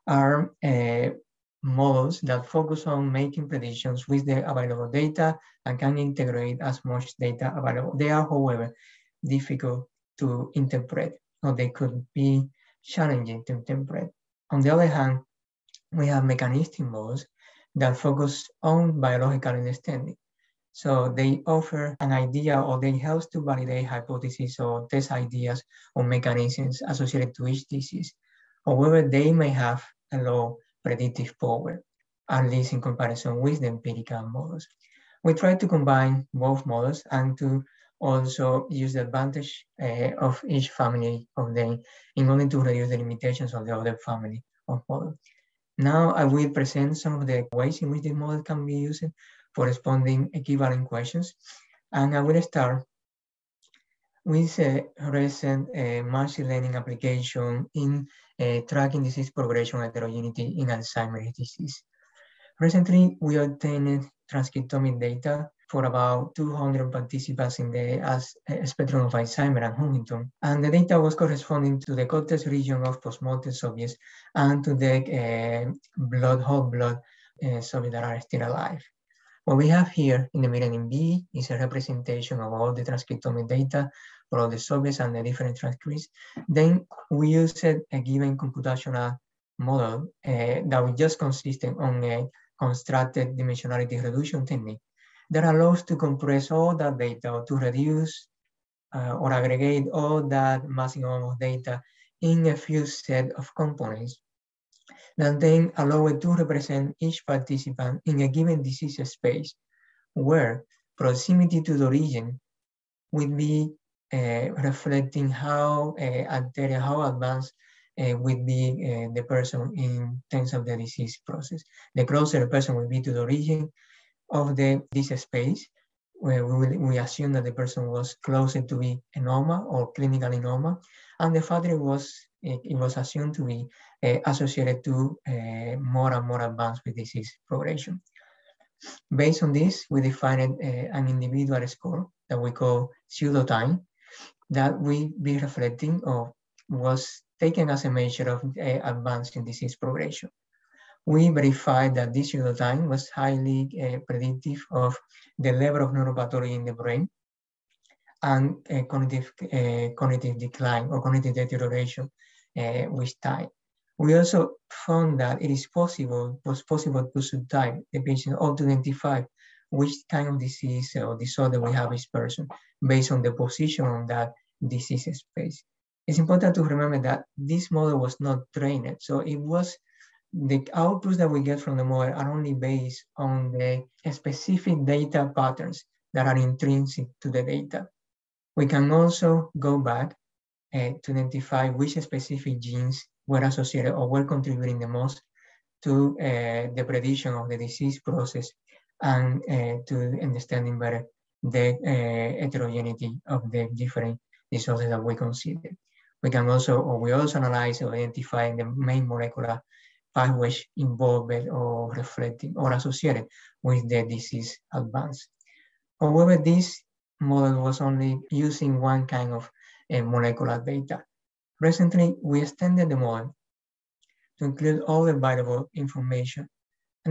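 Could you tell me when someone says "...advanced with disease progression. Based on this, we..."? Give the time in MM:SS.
02:16.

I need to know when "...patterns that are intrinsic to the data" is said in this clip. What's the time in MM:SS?
03:05.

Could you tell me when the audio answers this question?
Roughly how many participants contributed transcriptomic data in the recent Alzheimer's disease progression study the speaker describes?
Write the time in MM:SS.
01:06.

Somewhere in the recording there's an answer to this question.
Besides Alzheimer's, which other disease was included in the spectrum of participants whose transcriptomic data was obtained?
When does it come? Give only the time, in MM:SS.
01:09.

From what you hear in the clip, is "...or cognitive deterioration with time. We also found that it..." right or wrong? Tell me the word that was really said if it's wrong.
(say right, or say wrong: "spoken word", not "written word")
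right.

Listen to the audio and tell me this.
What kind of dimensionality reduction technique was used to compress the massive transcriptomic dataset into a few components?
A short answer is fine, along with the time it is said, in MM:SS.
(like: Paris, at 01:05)
Contrastive, at 01:32.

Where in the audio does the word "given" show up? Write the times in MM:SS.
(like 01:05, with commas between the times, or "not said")
01:28, 01:48.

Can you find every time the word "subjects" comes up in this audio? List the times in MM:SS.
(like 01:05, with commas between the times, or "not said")
01:13, 01:17, 01:24.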